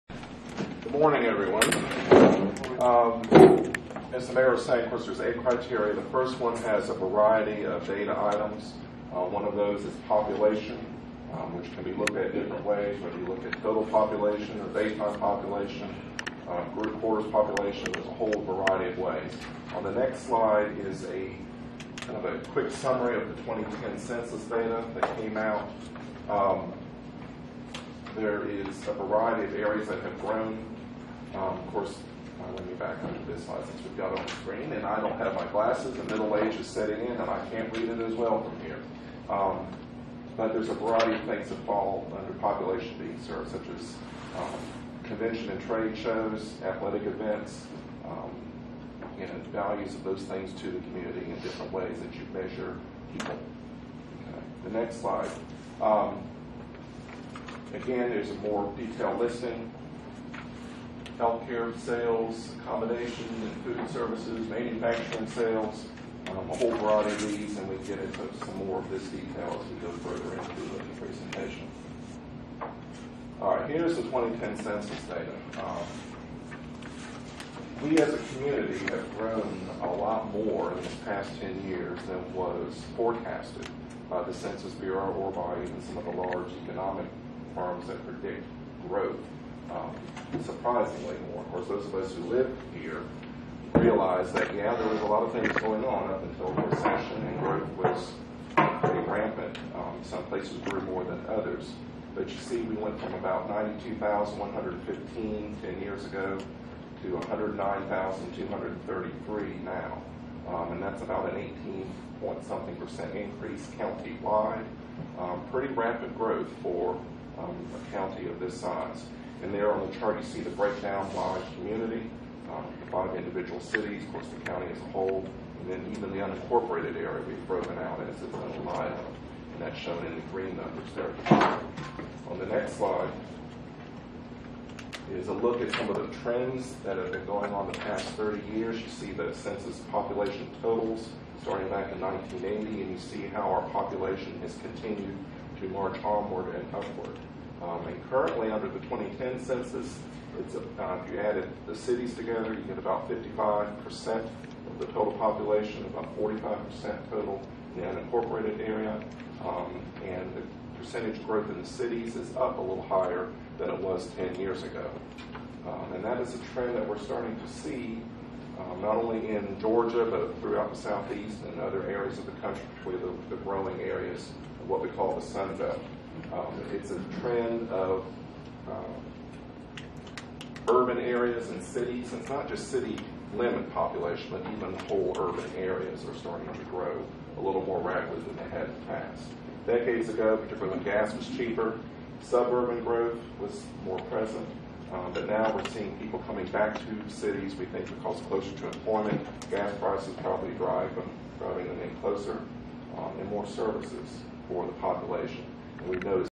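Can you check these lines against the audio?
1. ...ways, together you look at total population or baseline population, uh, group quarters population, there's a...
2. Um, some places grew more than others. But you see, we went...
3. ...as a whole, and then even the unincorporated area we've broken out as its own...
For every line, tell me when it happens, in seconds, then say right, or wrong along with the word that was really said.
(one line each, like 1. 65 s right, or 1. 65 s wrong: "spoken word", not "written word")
1. 12 s wrong: "whether", not "together"
2. 99 s right
3. 124 s right.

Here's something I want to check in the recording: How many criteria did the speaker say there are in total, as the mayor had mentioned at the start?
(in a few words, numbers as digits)
8.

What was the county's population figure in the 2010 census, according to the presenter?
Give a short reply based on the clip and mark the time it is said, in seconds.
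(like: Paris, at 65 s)
109,233, at 107 s.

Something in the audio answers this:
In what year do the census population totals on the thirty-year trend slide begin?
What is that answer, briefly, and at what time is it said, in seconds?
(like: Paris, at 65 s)
1980, at 141 s.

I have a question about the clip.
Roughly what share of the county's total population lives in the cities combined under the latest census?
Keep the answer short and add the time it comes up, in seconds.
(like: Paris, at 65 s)
55%, at 153 s.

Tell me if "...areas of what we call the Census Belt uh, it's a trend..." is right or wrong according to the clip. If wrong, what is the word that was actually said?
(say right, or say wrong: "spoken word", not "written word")
wrong: "Sun", not "Census".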